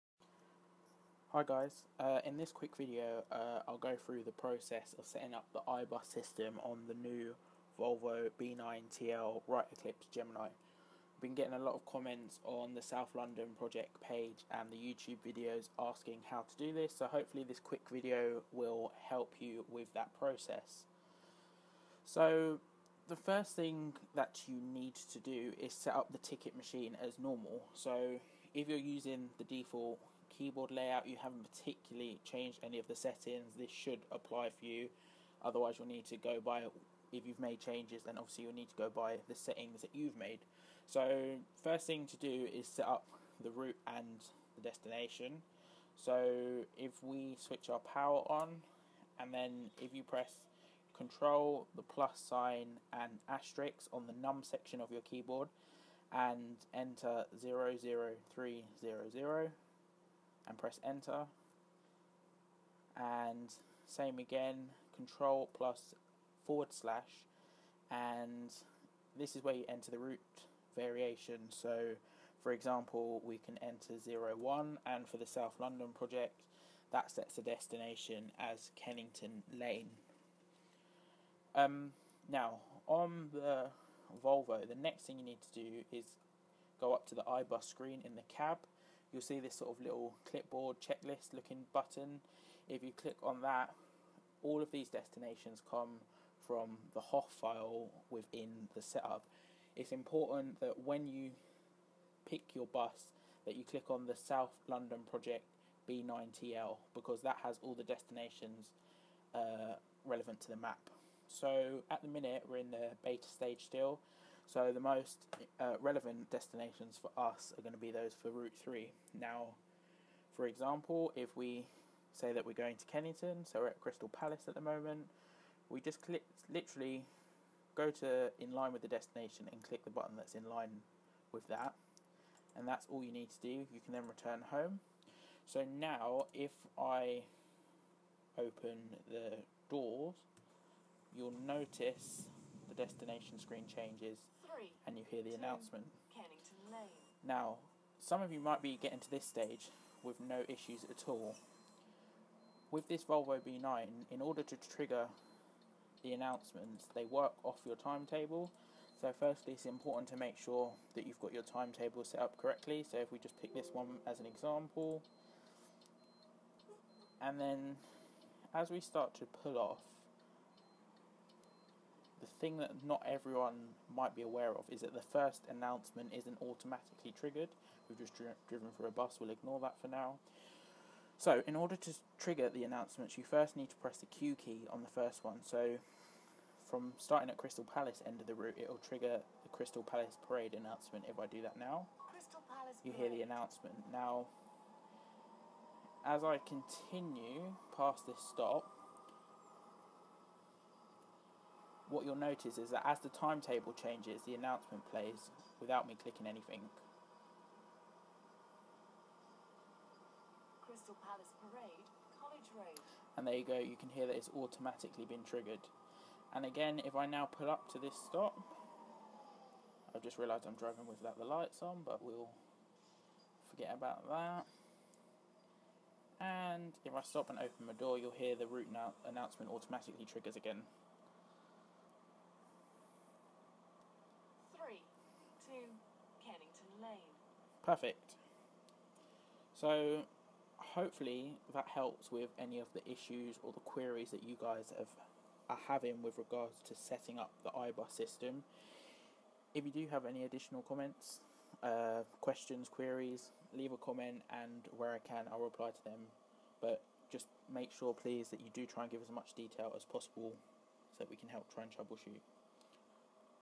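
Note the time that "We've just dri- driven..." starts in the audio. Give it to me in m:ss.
2:57.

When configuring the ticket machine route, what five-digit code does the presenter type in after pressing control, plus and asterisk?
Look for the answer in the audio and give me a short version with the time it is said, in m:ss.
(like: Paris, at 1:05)
00300, at 0:57.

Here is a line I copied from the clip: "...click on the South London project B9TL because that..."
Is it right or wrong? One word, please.
right.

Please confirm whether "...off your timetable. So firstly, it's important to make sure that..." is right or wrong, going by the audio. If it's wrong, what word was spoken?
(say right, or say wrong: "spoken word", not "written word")
right.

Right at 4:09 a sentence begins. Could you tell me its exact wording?
If you do have any additional comments, uh, questions, queries, leave a comment and where I can I'll reply to them.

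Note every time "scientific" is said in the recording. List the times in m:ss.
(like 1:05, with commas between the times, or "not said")
not said.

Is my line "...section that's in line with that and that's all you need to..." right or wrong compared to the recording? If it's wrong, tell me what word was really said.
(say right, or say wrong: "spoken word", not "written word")
wrong: "button", not "section".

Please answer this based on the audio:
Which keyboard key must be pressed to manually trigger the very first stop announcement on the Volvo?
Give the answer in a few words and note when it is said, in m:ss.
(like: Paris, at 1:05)
Q, at 3:04.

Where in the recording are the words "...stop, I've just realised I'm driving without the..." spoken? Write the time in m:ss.
3:38.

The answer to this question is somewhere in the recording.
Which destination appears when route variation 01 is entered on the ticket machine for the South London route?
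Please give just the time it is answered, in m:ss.
1:18.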